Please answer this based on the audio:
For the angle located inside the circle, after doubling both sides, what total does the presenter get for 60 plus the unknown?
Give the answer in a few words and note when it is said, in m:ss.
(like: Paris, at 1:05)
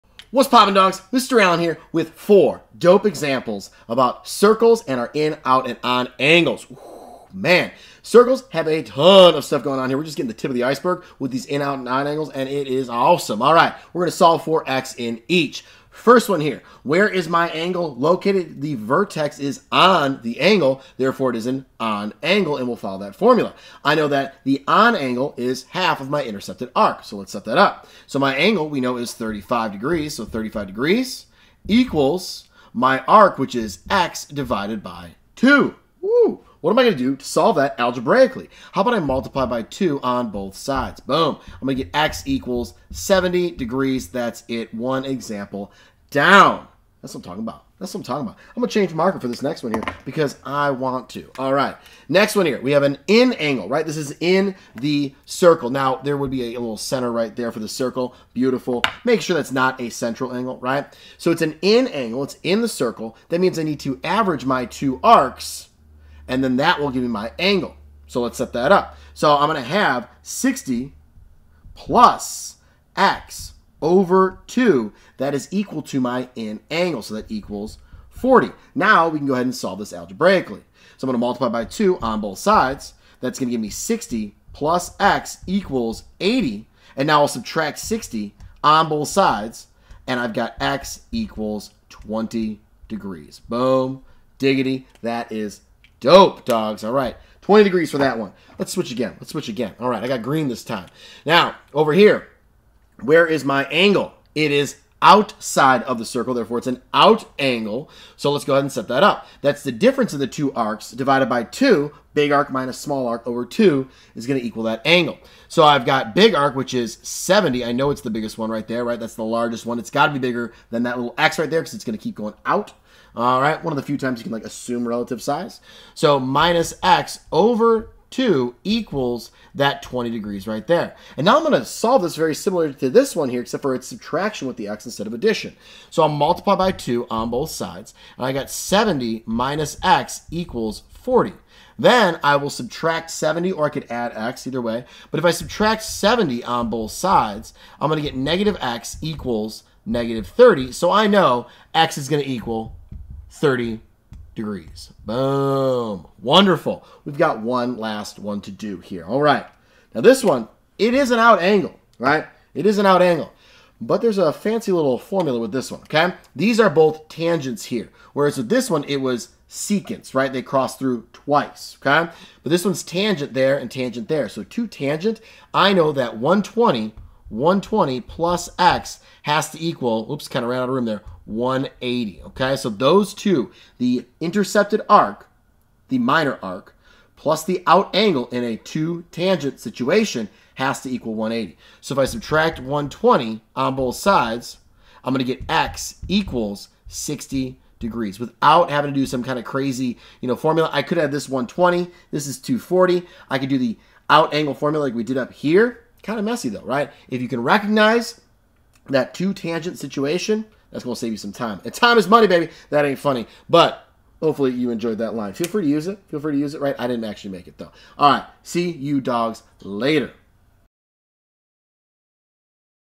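80, at 1:26.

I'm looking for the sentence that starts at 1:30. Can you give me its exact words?
And I've got x equals 20 degrees.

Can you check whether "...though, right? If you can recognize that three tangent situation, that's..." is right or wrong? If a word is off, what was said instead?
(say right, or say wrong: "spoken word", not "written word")
wrong: "two", not "three".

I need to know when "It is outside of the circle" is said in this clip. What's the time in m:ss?
1:44.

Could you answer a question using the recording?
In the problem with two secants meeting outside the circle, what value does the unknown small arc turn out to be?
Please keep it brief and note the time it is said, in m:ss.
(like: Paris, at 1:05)
30 degrees, at 2:33.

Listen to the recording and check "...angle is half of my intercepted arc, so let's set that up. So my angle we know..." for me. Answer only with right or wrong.
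right.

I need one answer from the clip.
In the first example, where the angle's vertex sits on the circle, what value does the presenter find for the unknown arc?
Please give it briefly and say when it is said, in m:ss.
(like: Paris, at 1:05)
70 degrees, at 0:41.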